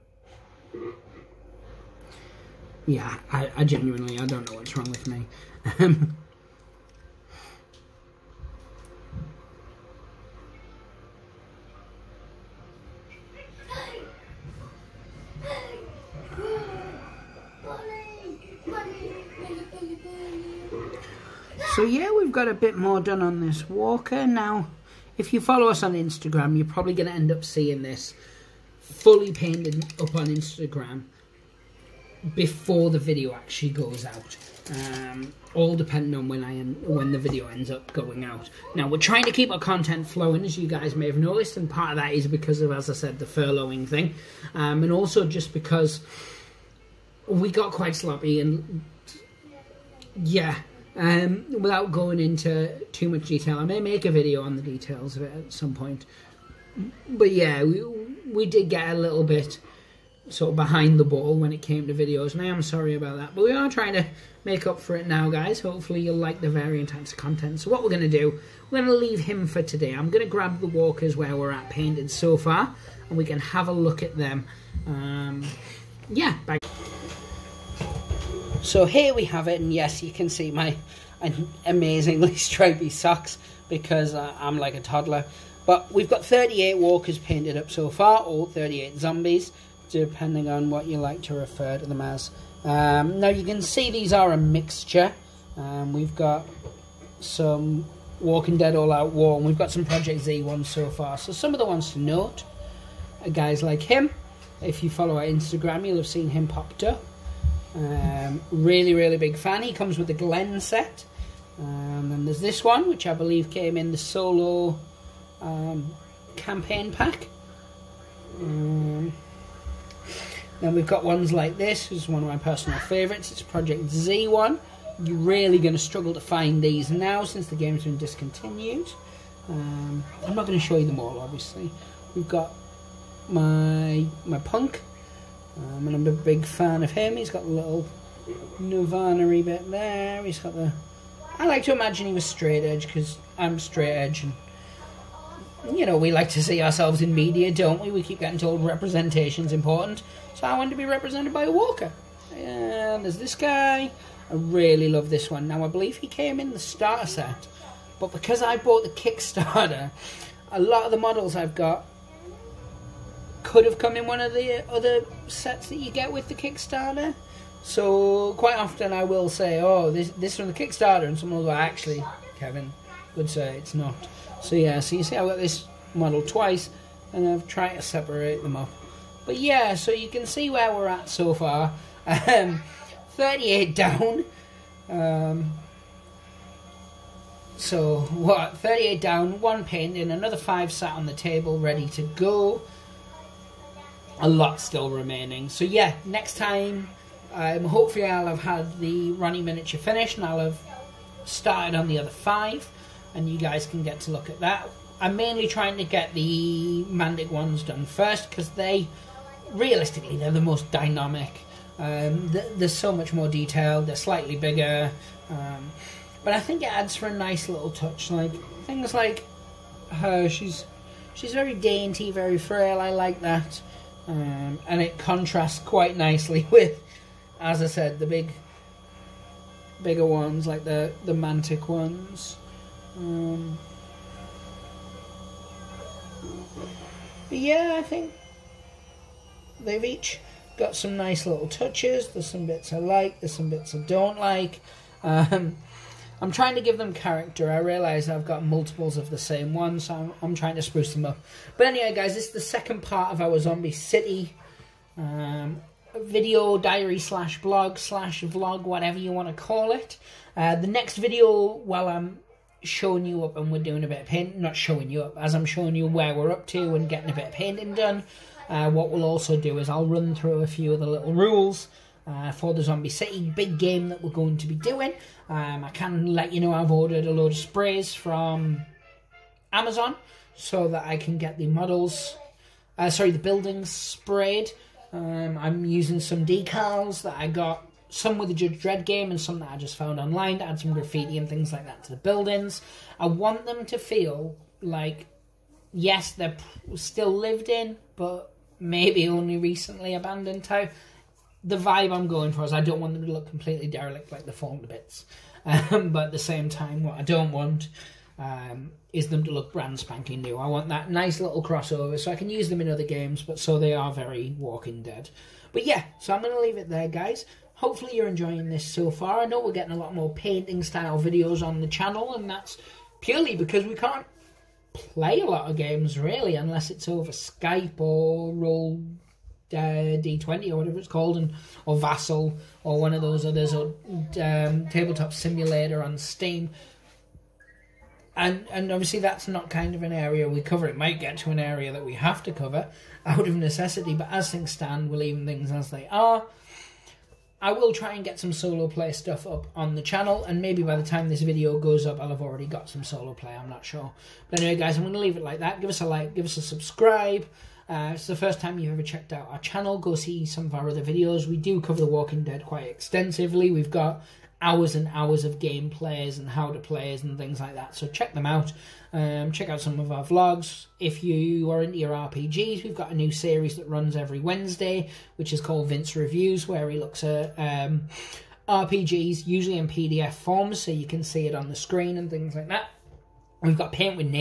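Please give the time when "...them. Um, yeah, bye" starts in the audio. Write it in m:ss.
1:14.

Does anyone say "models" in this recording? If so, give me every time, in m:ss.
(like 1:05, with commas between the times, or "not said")
2:40, 2:55, 4:41.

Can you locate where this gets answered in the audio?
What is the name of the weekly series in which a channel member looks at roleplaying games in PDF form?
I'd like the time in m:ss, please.
6:15.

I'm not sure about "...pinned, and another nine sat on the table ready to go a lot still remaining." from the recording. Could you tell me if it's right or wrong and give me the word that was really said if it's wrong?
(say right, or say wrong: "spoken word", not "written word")
wrong: "five", not "nine".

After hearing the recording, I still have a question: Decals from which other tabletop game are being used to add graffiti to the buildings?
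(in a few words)
Judge Dredd.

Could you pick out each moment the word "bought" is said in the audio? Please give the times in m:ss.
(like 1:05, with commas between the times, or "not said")
2:38.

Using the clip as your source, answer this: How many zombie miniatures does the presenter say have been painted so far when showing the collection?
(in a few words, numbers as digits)
38.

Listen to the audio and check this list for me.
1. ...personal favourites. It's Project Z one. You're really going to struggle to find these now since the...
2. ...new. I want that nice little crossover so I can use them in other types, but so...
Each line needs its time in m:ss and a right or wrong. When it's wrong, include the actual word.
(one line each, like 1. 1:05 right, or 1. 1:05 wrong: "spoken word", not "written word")
1. 2:02 right
2. 5:10 wrong: "games", not "types".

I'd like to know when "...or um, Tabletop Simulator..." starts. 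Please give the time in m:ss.
5:33.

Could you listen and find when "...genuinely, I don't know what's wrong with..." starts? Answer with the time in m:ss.
0:03.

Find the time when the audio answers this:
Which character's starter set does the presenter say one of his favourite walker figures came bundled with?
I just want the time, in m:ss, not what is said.
1:50.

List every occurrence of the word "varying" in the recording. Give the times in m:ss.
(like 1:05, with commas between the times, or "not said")
1:06.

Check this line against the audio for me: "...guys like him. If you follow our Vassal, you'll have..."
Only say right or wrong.
wrong.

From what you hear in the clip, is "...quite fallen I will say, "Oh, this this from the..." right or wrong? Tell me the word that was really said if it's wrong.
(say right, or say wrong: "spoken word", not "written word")
wrong: "often", not "fallen".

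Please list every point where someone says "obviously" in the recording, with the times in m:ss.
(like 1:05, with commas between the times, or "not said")
2:11, 5:38.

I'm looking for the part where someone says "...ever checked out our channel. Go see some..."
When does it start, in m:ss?
5:58.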